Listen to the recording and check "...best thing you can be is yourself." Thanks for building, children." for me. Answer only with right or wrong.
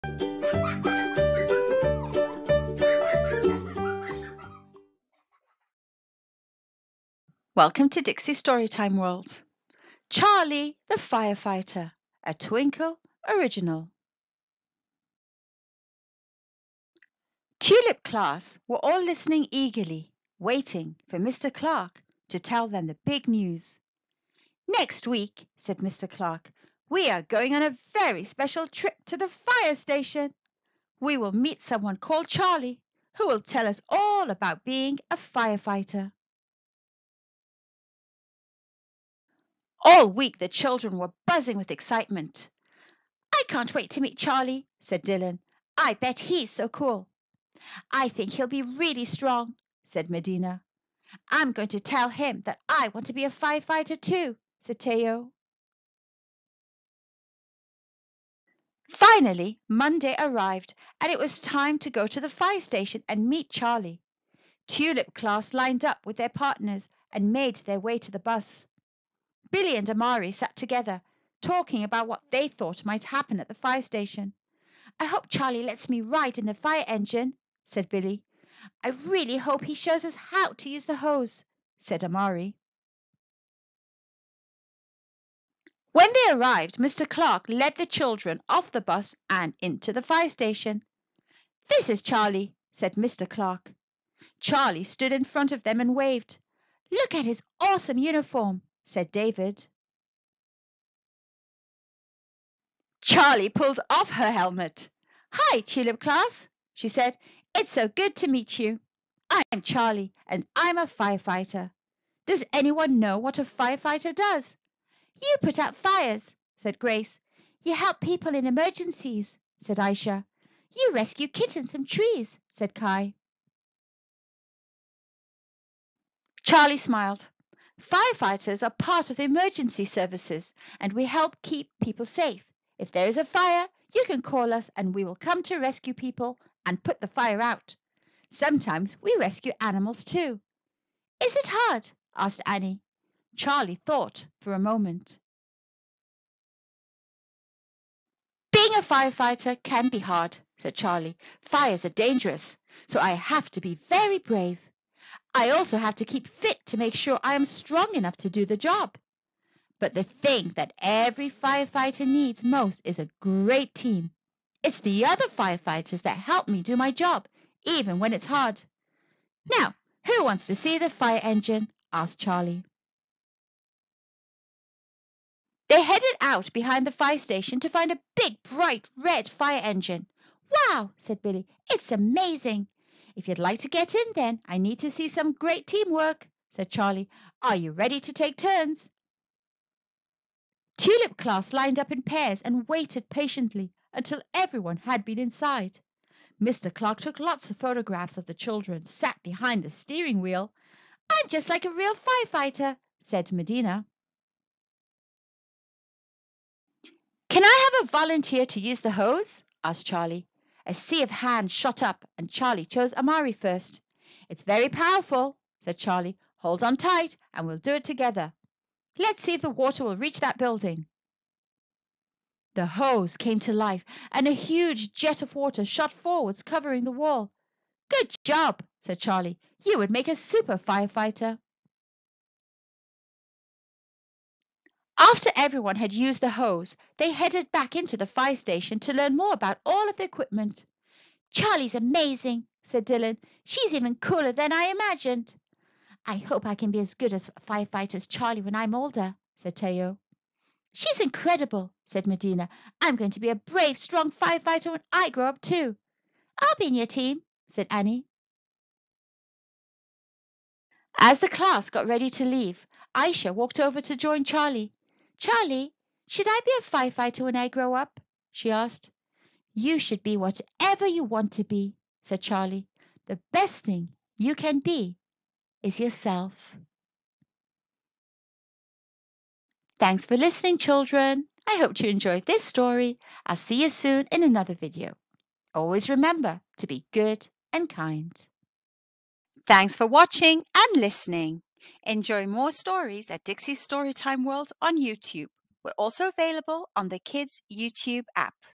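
wrong.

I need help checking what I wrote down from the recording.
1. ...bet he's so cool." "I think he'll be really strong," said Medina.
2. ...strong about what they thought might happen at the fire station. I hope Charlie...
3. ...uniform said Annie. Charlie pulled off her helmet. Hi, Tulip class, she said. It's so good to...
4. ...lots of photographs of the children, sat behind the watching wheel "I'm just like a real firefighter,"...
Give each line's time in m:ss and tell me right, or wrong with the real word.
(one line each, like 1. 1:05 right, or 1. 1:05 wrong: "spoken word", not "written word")
1. 0:45 right
2. 1:11 wrong: "talking", not "strong"
3. 1:37 wrong: "David", not "Annie"
4. 3:17 wrong: "steering", not "watching".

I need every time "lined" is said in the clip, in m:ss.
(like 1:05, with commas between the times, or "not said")
1:05, 3:11.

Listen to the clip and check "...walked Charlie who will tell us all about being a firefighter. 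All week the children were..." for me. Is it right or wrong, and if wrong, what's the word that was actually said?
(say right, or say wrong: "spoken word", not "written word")
wrong: "called", not "walked".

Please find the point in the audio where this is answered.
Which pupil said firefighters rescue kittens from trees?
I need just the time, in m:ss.
2:02.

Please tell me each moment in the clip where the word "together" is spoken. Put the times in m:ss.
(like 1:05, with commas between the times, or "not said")
1:10, 3:37.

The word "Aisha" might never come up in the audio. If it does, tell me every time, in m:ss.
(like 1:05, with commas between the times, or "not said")
1:59, 4:22.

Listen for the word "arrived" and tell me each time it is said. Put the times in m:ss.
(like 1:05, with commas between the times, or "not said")
1:00, 1:26.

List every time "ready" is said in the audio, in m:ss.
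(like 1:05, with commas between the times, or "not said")
3:07, 4:21.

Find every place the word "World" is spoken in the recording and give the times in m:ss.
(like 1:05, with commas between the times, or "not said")
0:08, 4:54.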